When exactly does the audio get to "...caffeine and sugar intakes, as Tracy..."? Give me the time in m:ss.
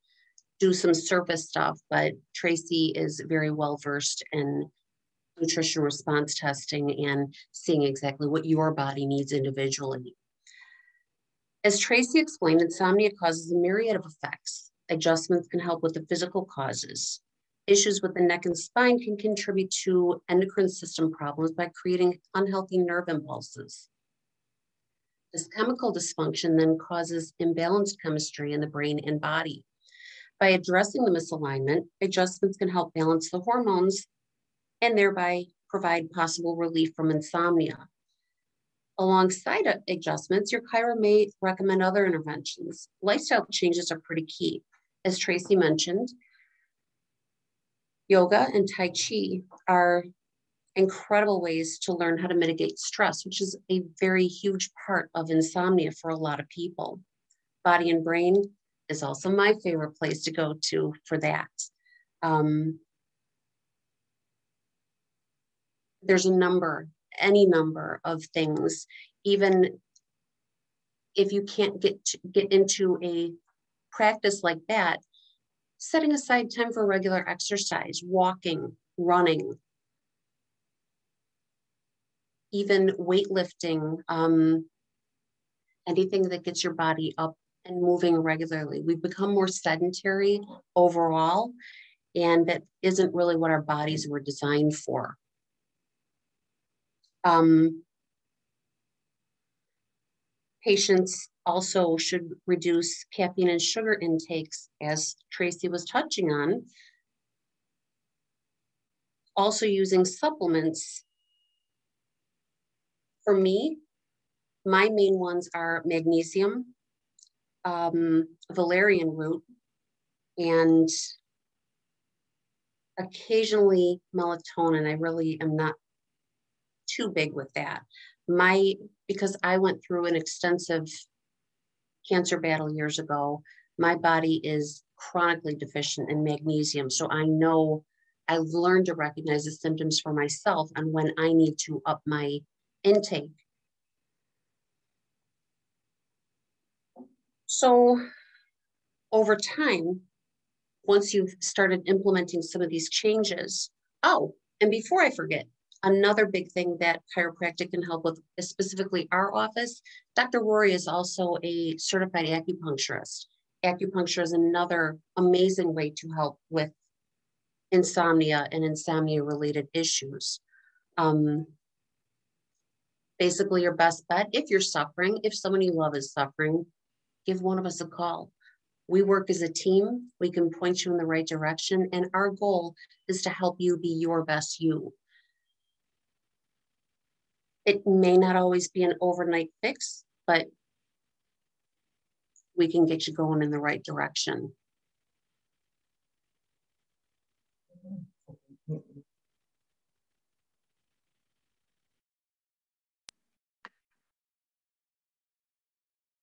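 1:43.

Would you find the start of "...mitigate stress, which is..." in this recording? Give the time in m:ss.
0:52.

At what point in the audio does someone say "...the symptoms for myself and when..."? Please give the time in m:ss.
2:19.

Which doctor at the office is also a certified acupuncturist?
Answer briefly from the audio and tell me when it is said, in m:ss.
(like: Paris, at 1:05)
Dr. Rory, at 2:40.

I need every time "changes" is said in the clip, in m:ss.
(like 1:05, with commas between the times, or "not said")
0:43, 2:32.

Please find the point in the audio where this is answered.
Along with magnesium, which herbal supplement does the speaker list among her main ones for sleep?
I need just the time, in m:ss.
1:58.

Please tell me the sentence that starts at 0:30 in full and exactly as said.
By addressing the misalignment, adjustments can help balance the hormones and thereby provide possible relief from insomnia.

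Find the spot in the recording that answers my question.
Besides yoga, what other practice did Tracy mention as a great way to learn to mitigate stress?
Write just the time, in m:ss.
0:48.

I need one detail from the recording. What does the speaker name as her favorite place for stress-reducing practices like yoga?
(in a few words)
Body and brain.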